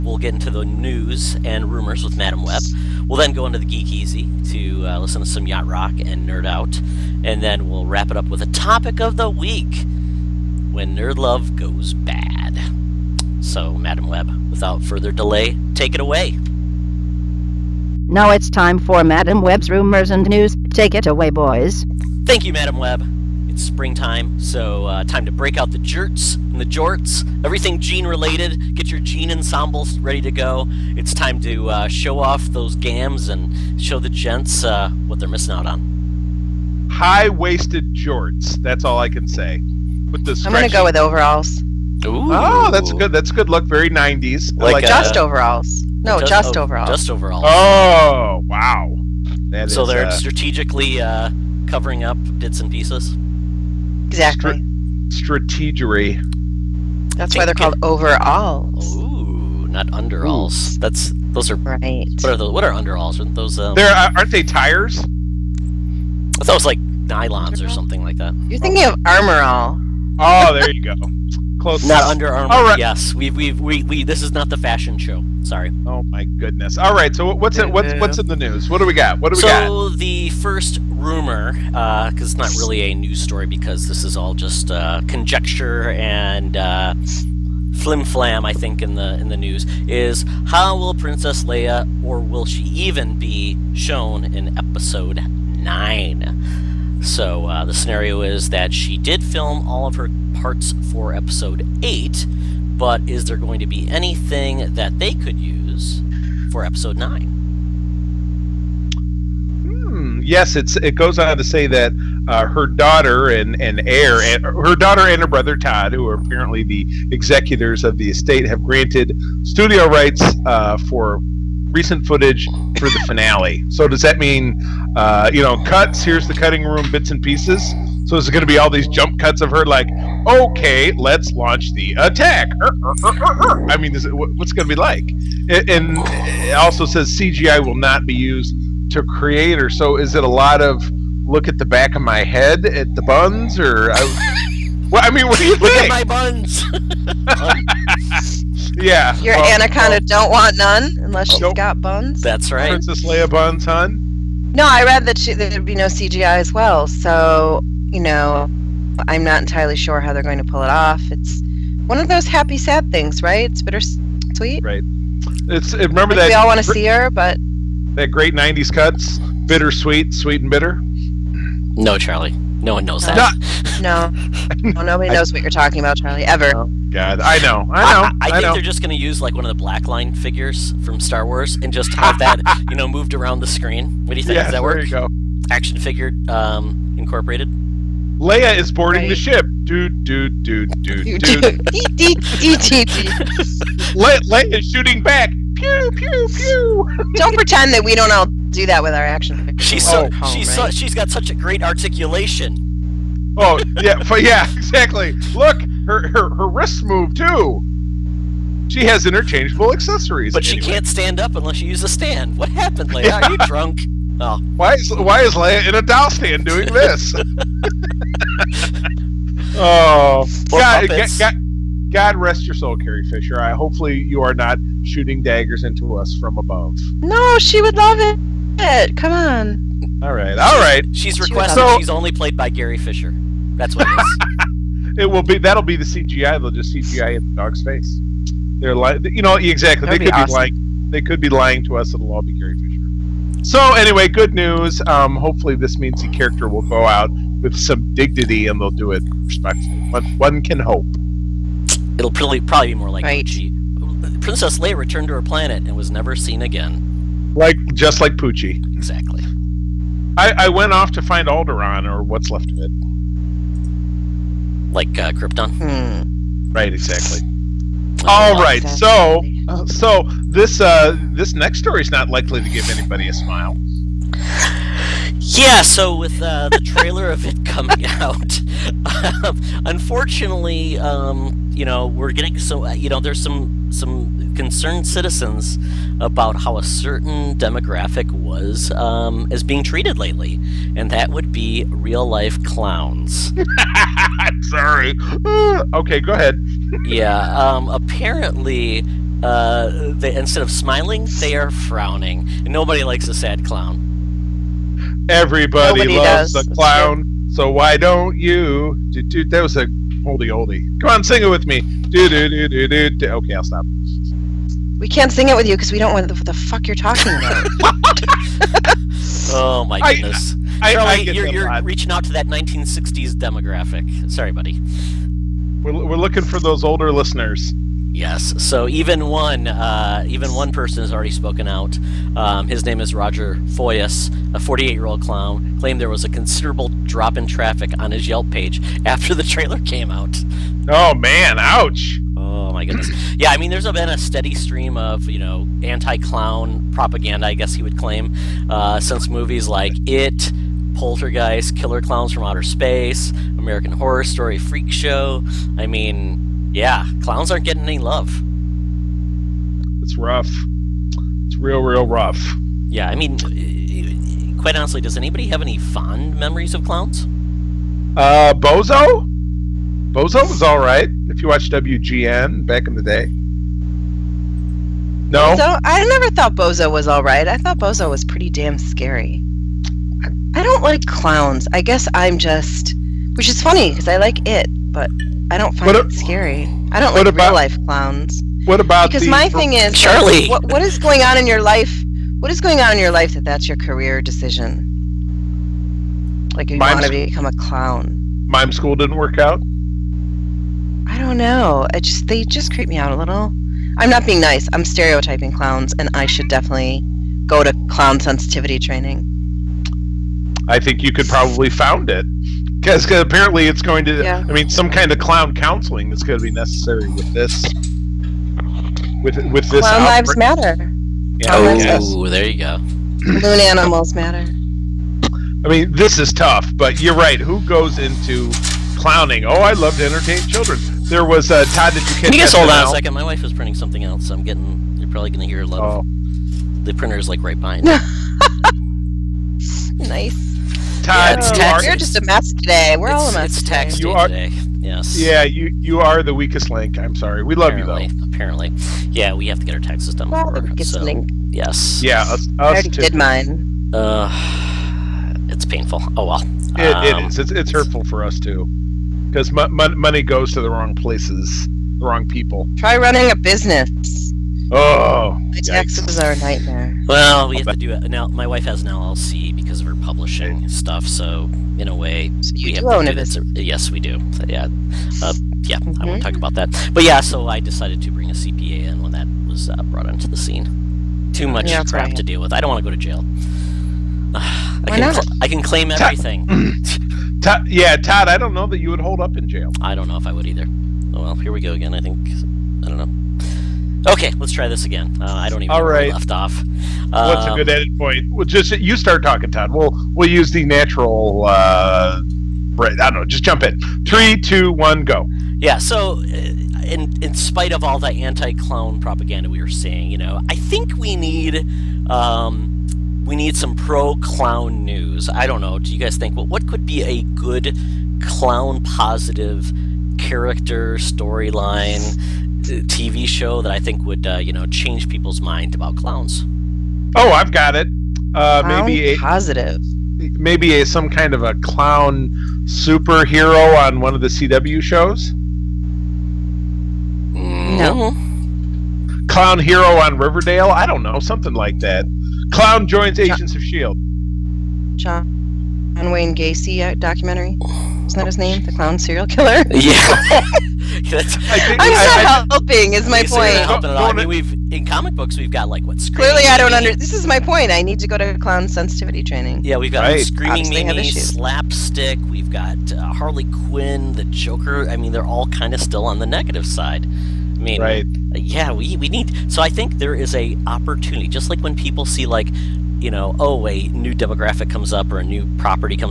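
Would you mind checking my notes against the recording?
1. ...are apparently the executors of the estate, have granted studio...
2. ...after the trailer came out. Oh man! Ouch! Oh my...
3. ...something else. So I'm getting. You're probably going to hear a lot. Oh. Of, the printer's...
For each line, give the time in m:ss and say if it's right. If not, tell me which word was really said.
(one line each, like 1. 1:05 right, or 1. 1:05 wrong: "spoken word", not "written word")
1. 1:56 right
2. 5:38 right
3. 7:13 right.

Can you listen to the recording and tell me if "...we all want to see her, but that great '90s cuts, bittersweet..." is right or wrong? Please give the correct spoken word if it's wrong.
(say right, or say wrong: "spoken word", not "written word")
right.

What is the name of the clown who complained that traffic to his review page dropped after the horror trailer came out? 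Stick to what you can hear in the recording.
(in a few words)
Roger Foyas.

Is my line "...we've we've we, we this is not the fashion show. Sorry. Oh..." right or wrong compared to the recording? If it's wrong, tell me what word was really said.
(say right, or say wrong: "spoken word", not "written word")
right.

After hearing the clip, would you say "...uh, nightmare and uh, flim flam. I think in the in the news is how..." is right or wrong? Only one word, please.
wrong.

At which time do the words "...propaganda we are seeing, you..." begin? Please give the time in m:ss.
8:28.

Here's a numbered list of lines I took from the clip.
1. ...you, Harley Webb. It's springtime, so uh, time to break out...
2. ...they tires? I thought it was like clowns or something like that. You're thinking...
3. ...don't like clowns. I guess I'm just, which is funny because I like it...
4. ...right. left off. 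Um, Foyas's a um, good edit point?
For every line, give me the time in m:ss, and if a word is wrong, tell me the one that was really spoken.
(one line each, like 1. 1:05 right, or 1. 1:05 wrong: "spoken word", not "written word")
1. 0:22 wrong: "Madam", not "Harley"
2. 1:04 wrong: "nylons", not "clowns"
3. 6:20 right
4. 8:15 wrong: "What", not "Foyas".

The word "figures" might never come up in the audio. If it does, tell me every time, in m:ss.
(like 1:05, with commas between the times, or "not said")
3:00, 3:05, 3:19.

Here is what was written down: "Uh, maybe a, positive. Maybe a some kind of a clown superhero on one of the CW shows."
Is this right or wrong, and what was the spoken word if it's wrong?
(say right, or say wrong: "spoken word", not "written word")
right.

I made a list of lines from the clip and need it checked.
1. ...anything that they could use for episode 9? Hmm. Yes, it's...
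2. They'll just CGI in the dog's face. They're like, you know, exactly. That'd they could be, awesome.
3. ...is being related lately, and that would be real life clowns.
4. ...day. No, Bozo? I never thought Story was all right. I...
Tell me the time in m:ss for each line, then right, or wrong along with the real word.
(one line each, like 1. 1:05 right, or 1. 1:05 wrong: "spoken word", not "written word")
1. 1:43 right
2. 3:56 right
3. 4:49 wrong: "treated", not "related"
4. 6:12 wrong: "Bozo", not "Story".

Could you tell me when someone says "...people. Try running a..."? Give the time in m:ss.
7:42.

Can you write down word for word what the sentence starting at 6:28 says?
What about because my thing is Charlie?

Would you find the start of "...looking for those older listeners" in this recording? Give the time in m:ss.
5:25.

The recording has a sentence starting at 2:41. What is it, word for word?
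It's one of those happy sad things, right?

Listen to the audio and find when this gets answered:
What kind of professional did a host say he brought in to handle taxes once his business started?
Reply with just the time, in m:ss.
7:58.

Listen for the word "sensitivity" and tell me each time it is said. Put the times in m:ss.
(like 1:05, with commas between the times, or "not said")
6:47, 9:18.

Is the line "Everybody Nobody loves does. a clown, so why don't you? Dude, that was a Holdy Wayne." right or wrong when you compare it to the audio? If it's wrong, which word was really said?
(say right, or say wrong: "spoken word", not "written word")
wrong: "Holdy", not "Wayne".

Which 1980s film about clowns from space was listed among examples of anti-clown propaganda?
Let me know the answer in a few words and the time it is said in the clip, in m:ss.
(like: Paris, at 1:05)
Killer Clowns from Outer Space, at 5:51.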